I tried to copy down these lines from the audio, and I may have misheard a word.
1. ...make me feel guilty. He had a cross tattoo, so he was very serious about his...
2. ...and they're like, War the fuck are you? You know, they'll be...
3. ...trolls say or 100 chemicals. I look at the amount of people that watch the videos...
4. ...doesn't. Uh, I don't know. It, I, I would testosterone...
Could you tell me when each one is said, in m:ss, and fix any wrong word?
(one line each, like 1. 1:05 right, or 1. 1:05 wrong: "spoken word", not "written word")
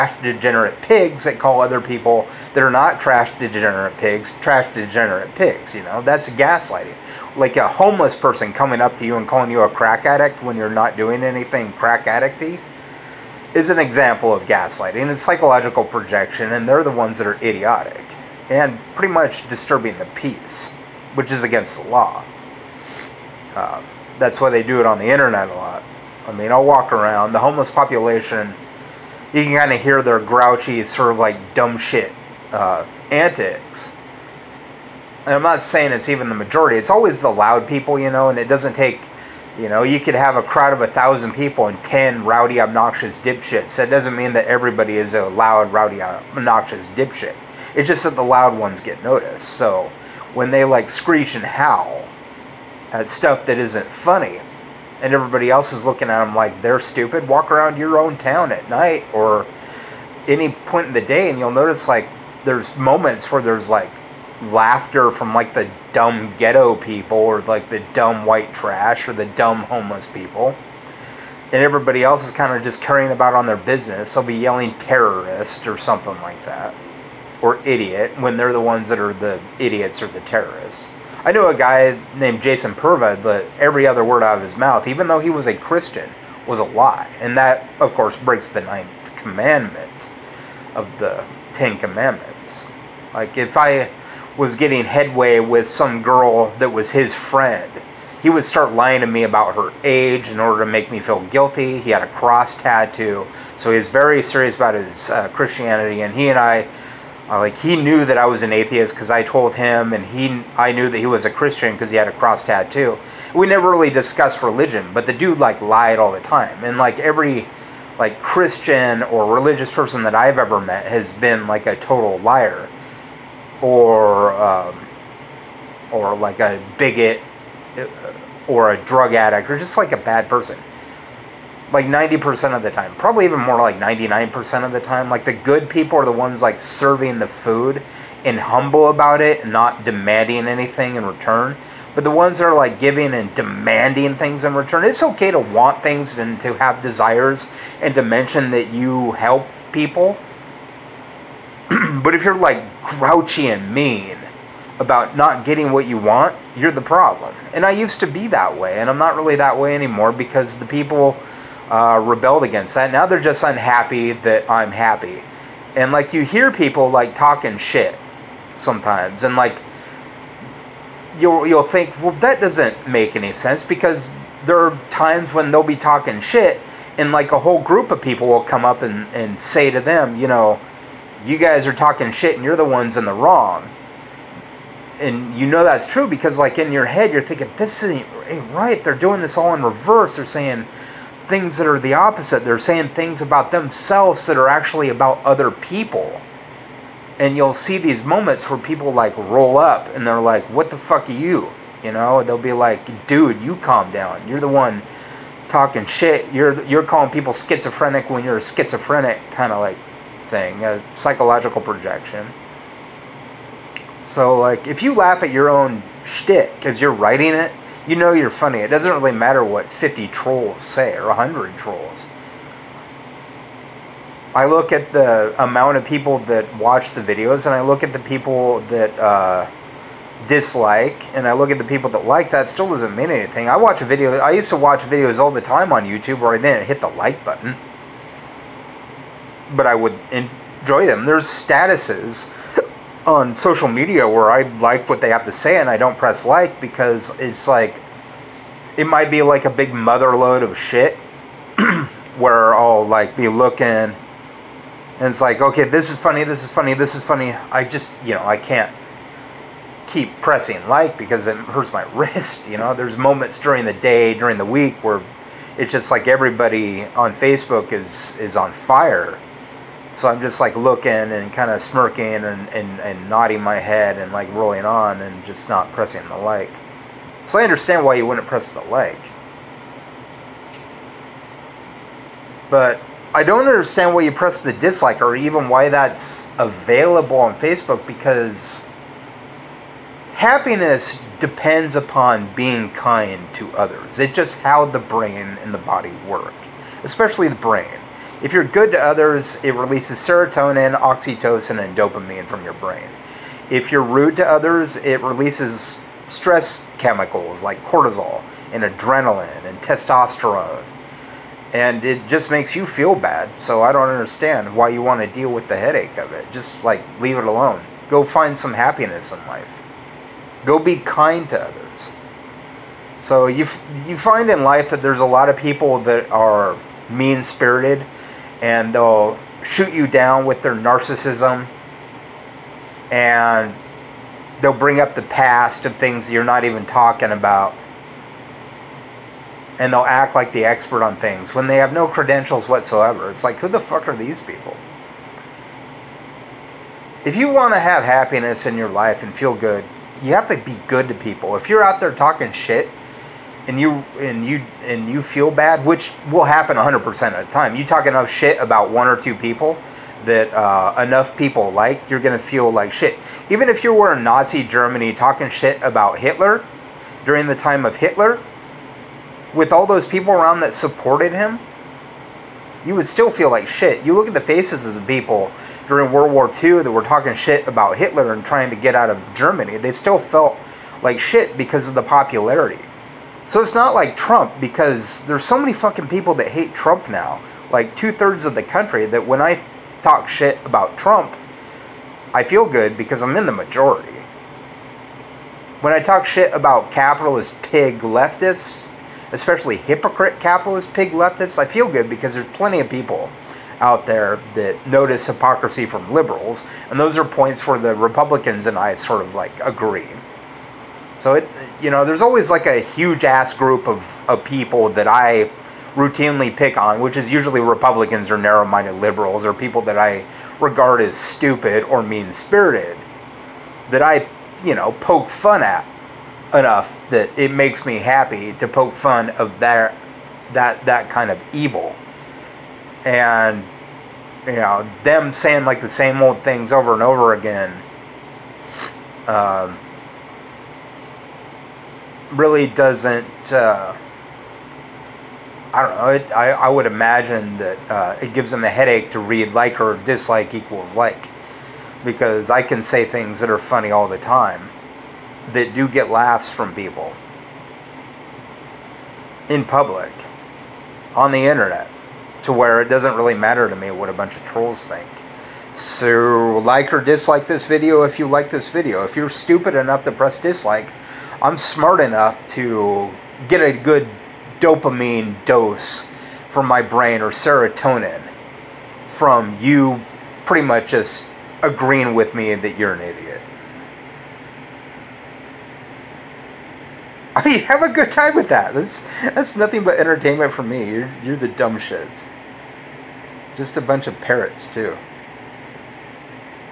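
1. 1:40 right
2. 3:19 wrong: "What", not "War"
3. 3:40 wrong: "trolls", not "chemicals"
4. 7:22 wrong: "imagine", not "testosterone".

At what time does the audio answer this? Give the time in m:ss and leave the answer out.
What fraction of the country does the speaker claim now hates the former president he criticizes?
6:27.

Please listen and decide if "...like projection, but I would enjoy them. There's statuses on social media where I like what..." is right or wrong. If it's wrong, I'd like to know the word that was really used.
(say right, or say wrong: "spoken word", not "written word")
wrong: "button", not "projection".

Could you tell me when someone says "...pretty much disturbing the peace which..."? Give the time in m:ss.
0:18.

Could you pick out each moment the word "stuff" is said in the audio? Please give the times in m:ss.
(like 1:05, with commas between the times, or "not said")
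0:53.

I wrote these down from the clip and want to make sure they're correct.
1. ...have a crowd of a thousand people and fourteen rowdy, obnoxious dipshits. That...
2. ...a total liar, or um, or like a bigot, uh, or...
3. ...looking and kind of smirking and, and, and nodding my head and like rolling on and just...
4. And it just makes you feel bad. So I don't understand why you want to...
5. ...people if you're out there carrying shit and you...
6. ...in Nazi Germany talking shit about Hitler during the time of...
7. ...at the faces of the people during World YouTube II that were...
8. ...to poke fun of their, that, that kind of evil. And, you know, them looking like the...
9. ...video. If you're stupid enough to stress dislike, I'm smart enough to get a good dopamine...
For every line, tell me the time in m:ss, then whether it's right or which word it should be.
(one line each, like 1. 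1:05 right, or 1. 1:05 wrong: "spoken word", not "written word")
1. 0:40 wrong: "ten", not "fourteen"
2. 2:01 right
3. 4:30 right
4. 5:11 right
5. 5:50 wrong: "talking", not "carrying"
6. 6:03 right
7. 6:14 wrong: "War", not "YouTube"
8. 7:08 wrong: "saying", not "looking"
9. 7:48 wrong: "press", not "stress".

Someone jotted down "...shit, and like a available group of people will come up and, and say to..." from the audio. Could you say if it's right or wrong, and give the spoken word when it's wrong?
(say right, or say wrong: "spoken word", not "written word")
wrong: "whole", not "available".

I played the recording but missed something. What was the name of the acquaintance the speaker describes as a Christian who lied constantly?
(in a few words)
Jason Purva.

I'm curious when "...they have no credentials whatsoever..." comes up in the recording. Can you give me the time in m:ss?
5:41.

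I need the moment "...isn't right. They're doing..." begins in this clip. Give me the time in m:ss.
3:07.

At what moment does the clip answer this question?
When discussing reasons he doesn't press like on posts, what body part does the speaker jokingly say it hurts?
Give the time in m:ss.
4:21.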